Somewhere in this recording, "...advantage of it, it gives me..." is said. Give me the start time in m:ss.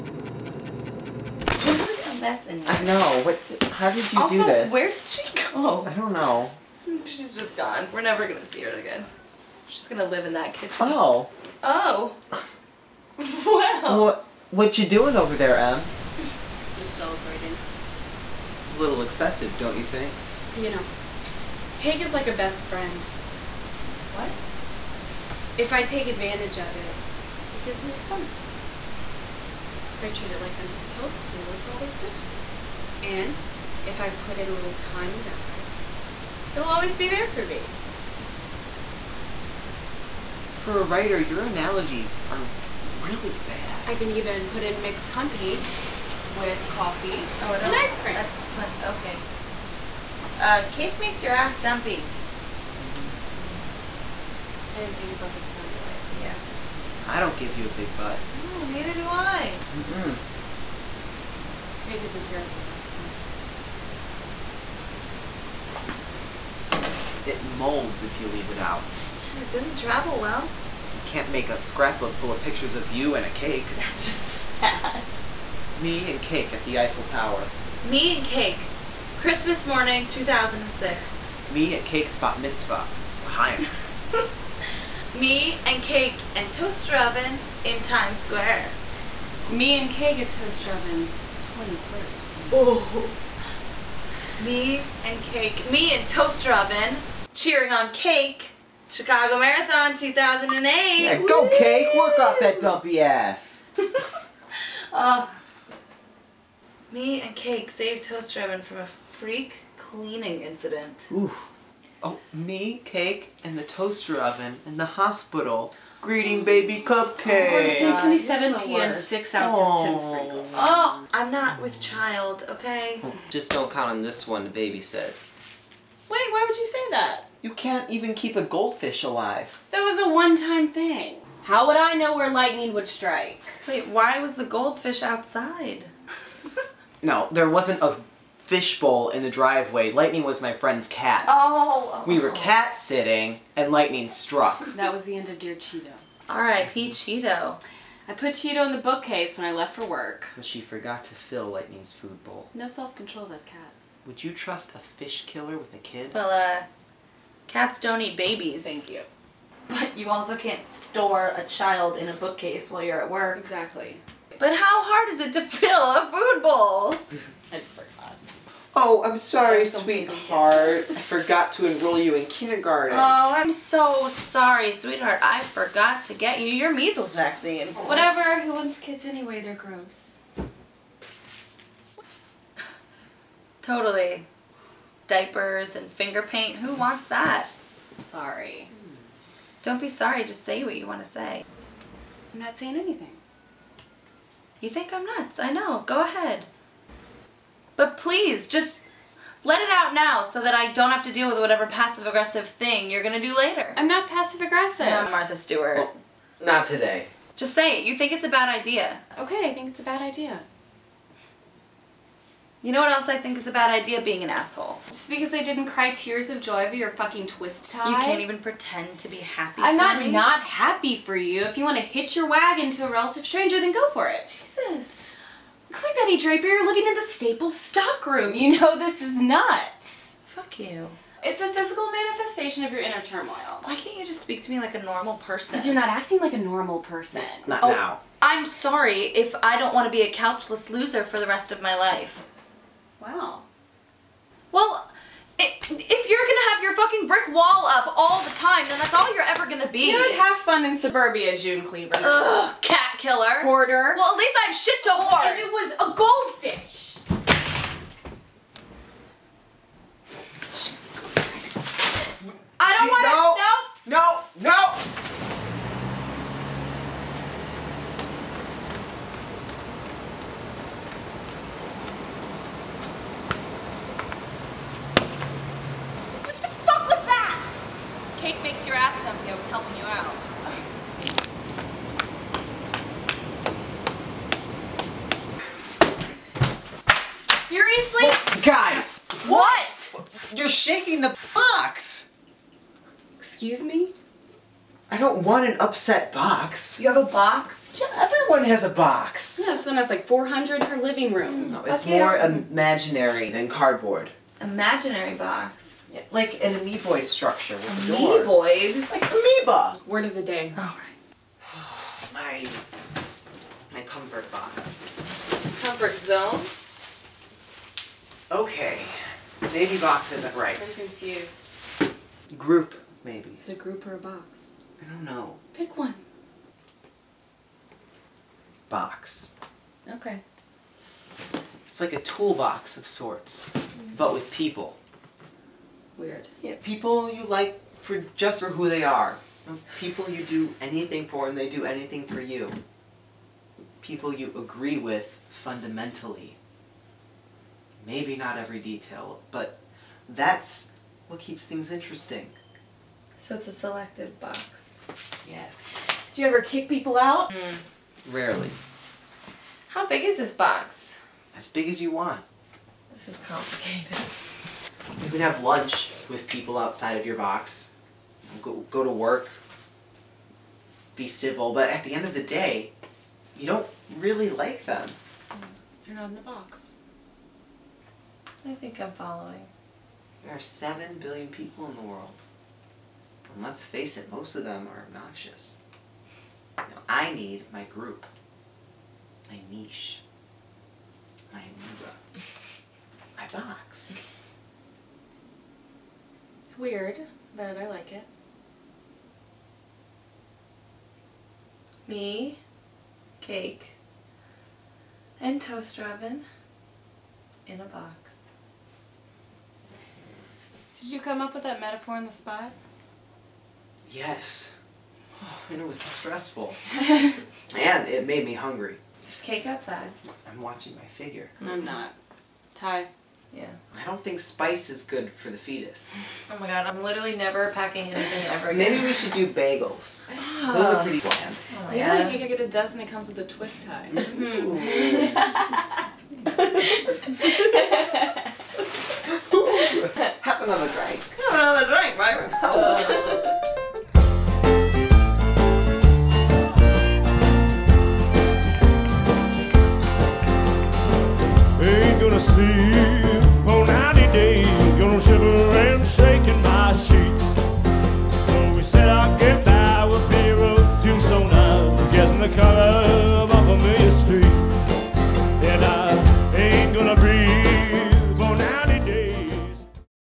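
0:26.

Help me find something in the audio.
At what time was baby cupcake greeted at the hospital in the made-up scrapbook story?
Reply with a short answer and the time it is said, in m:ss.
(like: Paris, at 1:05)
1:27 p.m., at 1:57.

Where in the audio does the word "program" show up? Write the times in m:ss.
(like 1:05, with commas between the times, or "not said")
not said.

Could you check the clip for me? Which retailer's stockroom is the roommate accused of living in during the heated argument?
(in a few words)
Staples.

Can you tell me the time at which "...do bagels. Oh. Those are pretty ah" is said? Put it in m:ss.
7:09.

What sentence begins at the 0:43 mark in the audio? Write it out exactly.
I can even put in mixed company with coffee oh, and no.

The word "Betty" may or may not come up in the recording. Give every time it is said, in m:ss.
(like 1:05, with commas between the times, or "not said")
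3:46.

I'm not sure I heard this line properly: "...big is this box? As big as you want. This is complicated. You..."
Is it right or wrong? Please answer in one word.
right.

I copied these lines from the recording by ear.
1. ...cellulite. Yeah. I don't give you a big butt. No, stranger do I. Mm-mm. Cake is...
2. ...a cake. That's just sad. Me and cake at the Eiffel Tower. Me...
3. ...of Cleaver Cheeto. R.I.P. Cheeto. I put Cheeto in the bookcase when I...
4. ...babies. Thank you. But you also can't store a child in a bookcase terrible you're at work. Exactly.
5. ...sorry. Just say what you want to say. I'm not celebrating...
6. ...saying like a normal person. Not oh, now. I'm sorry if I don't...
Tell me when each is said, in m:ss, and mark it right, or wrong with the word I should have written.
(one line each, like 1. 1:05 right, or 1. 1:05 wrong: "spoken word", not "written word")
1. 0:55 wrong: "neither", not "stranger"
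2. 1:13 right
3. 2:25 wrong: "Dear", not "Cleaver"
4. 2:38 wrong: "while", not "terrible"
5. 3:09 wrong: "saying", not "celebrating"
6. 3:55 wrong: "acting", not "saying".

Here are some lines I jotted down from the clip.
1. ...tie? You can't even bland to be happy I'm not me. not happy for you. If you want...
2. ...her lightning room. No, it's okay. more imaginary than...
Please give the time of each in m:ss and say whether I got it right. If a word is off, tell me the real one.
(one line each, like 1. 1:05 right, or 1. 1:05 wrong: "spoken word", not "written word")
1. 3:37 wrong: "pretend", not "bland"
2. 5:00 wrong: "living", not "lightning".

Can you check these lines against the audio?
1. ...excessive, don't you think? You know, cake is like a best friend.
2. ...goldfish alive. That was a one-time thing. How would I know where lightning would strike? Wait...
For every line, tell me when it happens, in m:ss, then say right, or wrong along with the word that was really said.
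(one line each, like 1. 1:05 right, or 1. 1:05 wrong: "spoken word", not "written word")
1. 0:19 right
2. 2:08 right.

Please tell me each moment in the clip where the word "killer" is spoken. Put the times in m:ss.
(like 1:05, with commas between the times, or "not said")
2:35, 4:12.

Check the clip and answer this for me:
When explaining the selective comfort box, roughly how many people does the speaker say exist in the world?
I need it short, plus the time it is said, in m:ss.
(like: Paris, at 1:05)
7 billion, at 6:20.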